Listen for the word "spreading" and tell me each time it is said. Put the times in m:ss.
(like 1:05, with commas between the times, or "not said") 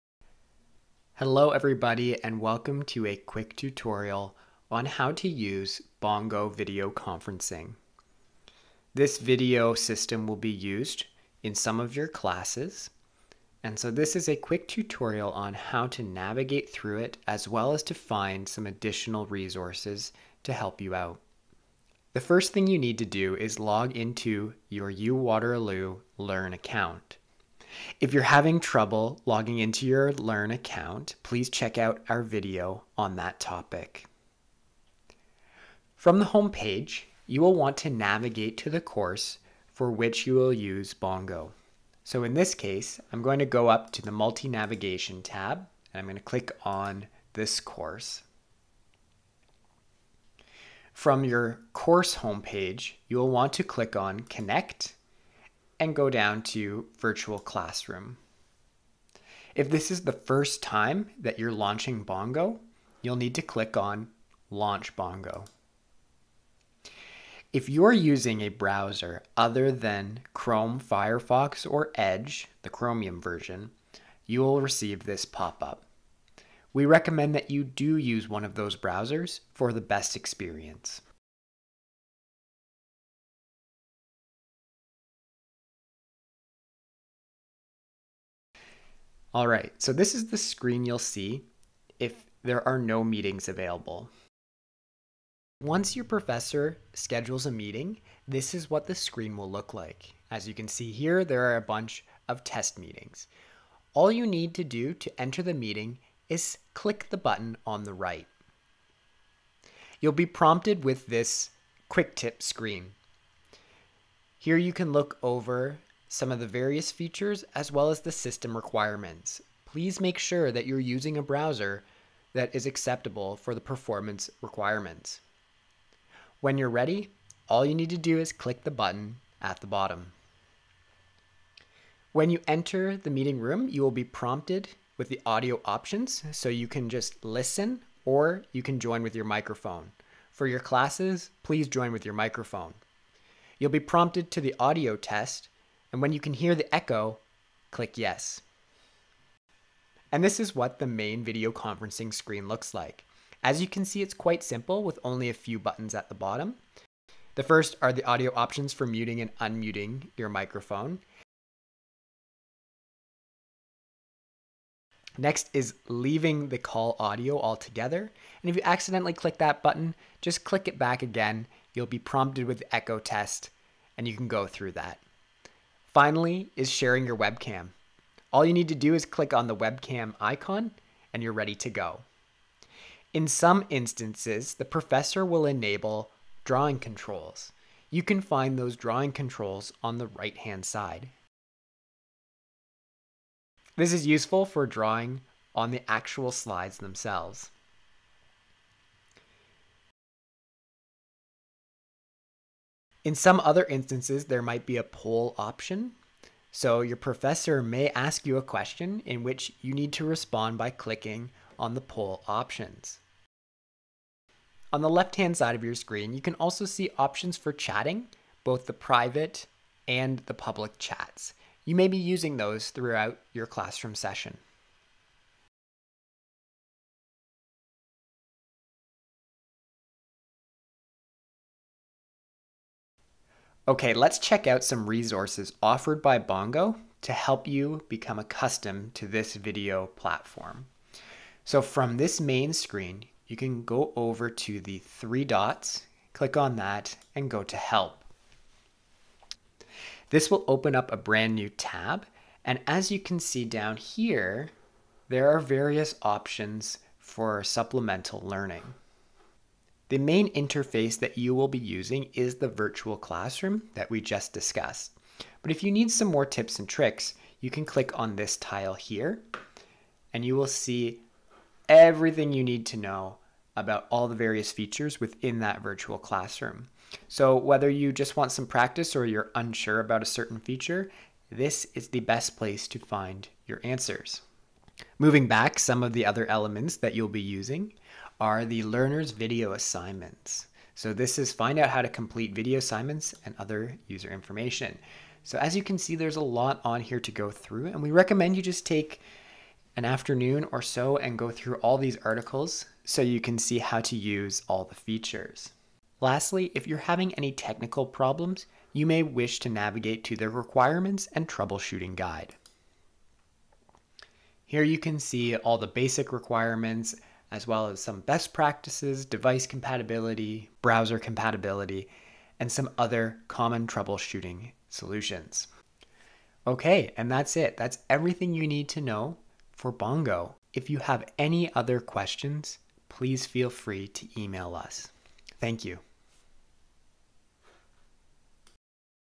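not said.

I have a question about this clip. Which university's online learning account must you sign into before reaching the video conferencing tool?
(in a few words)
UWaterloo.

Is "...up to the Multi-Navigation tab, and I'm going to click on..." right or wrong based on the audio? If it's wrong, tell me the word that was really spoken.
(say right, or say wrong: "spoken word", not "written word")
right.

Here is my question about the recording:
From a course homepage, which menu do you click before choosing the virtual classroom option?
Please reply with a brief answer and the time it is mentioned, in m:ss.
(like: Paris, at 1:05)
Connect, at 0:54.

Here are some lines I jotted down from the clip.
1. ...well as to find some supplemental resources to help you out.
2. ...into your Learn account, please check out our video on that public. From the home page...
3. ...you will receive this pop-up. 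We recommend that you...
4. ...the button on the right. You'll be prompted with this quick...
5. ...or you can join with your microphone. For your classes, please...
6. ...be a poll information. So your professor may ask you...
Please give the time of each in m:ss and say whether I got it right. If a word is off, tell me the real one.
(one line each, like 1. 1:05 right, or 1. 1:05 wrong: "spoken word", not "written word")
1. 0:17 wrong: "additional", not "supplemental"
2. 0:29 wrong: "topic", not "public"
3. 1:14 right
4. 1:47 right
5. 2:18 right
6. 3:24 wrong: "option", not "information".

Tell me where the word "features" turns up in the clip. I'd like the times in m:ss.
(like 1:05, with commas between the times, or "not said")
1:56, 4:34, 4:40, 5:04.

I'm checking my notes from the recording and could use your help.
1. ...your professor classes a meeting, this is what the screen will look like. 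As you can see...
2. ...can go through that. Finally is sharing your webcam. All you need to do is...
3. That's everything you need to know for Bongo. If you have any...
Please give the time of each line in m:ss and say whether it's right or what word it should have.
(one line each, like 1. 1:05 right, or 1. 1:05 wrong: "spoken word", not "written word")
1. 1:35 wrong: "schedules", not "classes"
2. 2:54 right
3. 5:27 right.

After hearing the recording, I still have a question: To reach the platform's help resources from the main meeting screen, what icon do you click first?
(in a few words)
three dots.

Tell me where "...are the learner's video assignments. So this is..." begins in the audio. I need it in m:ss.
4:48.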